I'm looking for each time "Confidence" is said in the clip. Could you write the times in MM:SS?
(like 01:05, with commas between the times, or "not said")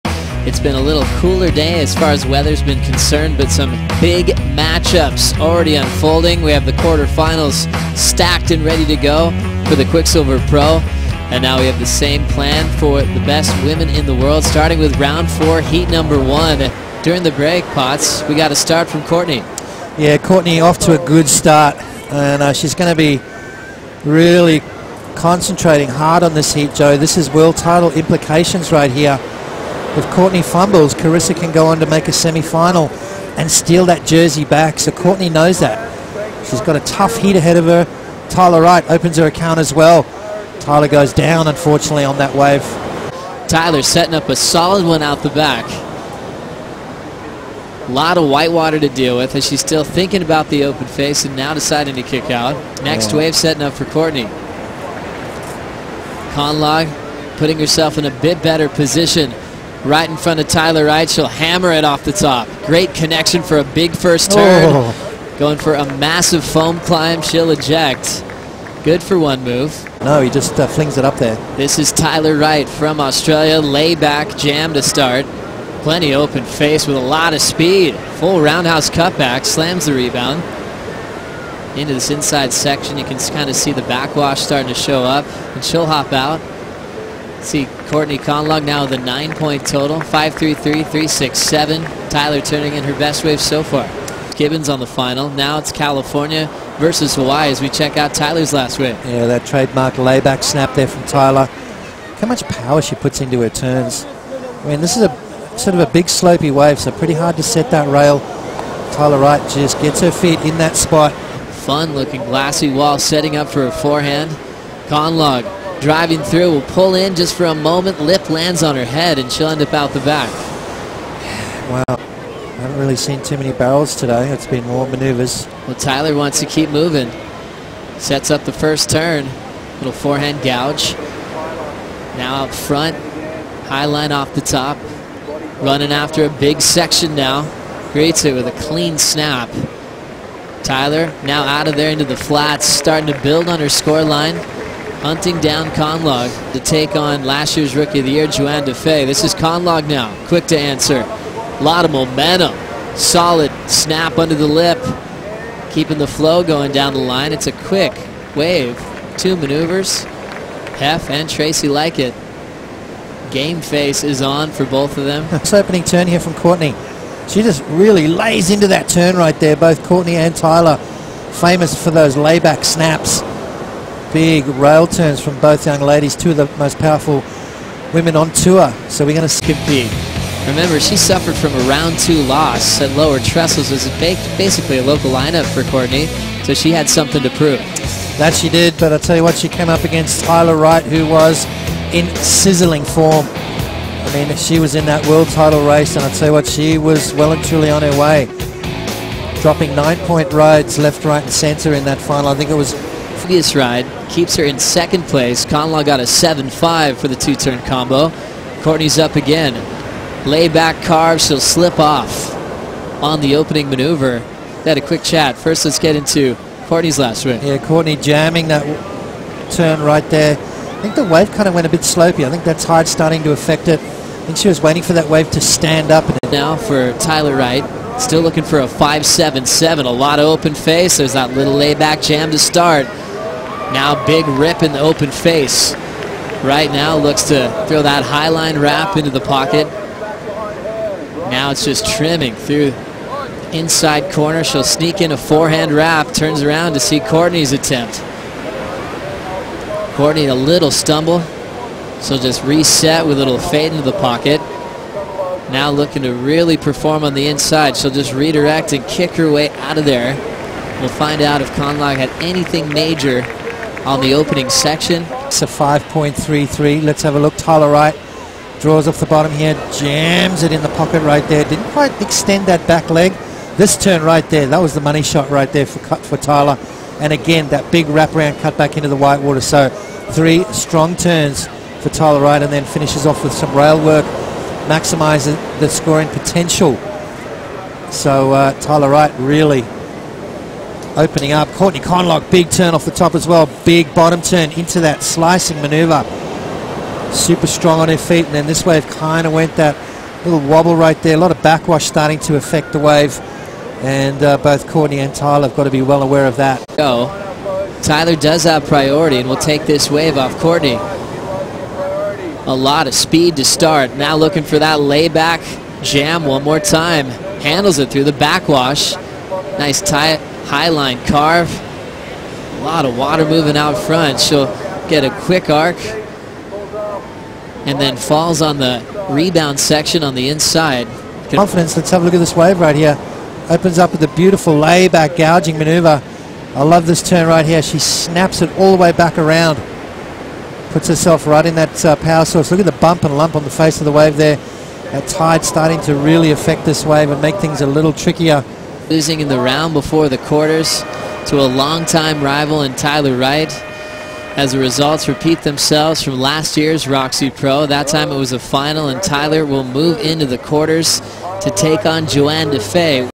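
05:31.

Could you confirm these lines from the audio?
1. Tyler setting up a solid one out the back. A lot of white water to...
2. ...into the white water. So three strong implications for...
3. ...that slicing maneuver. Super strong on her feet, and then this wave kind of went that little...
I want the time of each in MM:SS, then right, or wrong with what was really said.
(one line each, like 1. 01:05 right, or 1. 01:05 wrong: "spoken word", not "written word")
1. 00:43 right
2. 04:38 wrong: "turns", not "implications"
3. 04:54 right.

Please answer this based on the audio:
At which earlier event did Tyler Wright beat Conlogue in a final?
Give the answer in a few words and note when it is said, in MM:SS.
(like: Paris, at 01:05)
Roxy Pro, at 05:56.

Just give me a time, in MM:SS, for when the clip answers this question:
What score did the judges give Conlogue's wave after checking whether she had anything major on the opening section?
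04:25.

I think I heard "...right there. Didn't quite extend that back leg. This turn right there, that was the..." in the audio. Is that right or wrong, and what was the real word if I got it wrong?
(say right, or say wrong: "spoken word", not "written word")
right.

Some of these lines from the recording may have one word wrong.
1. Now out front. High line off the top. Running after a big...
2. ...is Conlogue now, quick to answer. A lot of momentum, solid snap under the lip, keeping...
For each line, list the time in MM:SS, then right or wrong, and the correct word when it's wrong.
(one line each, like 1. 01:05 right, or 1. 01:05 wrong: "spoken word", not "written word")
1. 02:12 right
2. 02:29 right.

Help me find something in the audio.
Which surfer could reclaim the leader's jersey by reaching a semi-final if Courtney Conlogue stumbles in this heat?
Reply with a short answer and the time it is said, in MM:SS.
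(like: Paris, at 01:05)
Carissa, at 00:30.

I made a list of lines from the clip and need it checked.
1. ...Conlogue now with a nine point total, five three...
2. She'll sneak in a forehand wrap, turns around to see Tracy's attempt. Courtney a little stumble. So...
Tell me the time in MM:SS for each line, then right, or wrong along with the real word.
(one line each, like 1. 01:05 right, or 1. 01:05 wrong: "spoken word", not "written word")
1. 01:28 right
2. 04:04 wrong: "Courtney", not "Tracy".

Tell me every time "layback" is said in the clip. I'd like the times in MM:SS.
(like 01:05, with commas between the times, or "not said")
01:13, 01:39, 02:52, 03:30, 03:51, 05:14, 05:34.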